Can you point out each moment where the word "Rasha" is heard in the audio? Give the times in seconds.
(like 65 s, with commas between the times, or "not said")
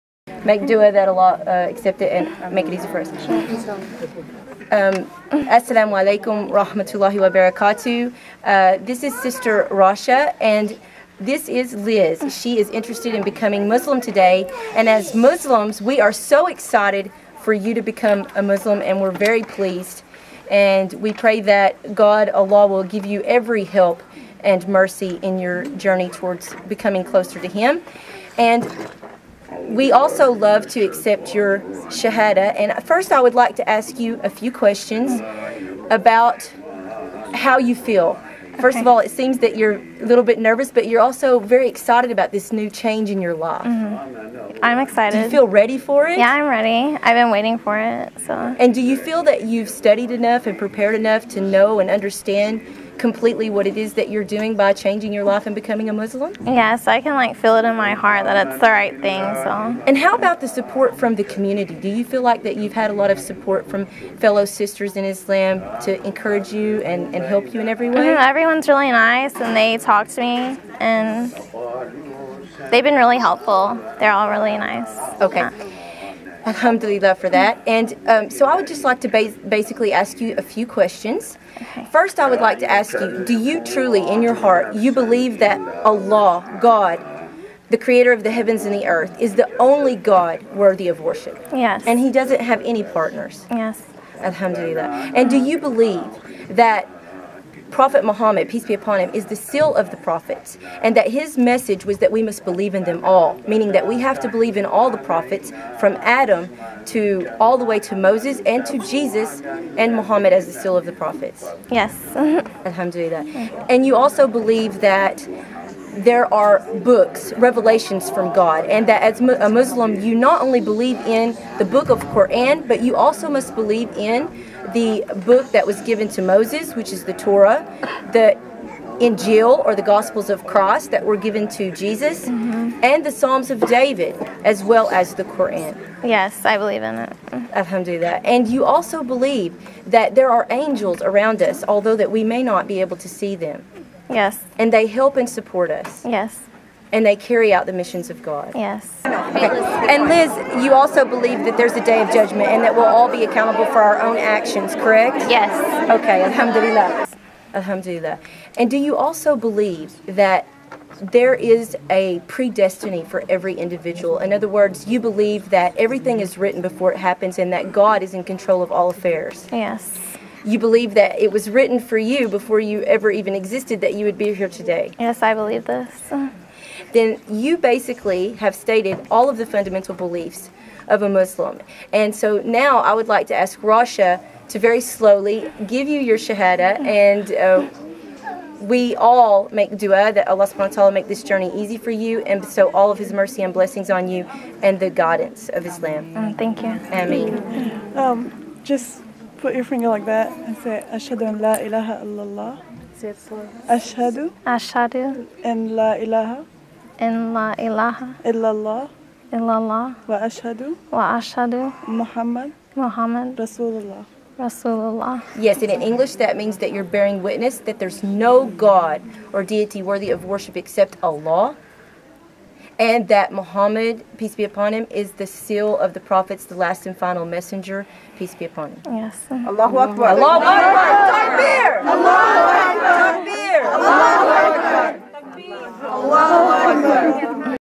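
9 s, 183 s.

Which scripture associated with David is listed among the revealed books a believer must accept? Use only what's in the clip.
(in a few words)
The Psalms.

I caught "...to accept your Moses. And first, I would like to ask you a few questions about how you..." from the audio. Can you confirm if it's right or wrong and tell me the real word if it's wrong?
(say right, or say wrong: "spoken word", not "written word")
wrong: "Shahada", not "Moses".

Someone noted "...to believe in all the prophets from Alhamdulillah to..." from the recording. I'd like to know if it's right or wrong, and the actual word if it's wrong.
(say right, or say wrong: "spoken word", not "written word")
wrong: "Adam", not "Alhamdulillah".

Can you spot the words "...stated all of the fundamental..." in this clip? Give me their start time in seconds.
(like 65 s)
178 s.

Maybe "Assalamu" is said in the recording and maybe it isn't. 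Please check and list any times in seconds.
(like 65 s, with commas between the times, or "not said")
5 s.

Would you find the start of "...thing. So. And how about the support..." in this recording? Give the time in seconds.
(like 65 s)
59 s.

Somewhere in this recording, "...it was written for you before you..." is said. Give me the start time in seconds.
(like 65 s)
171 s.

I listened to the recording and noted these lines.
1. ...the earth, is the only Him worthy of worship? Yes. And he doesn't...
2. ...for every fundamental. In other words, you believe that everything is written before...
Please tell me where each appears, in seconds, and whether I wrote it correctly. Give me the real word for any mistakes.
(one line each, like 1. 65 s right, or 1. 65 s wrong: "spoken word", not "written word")
1. 88 s wrong: "God", not "Him"
2. 163 s wrong: "individual", not "fundamental".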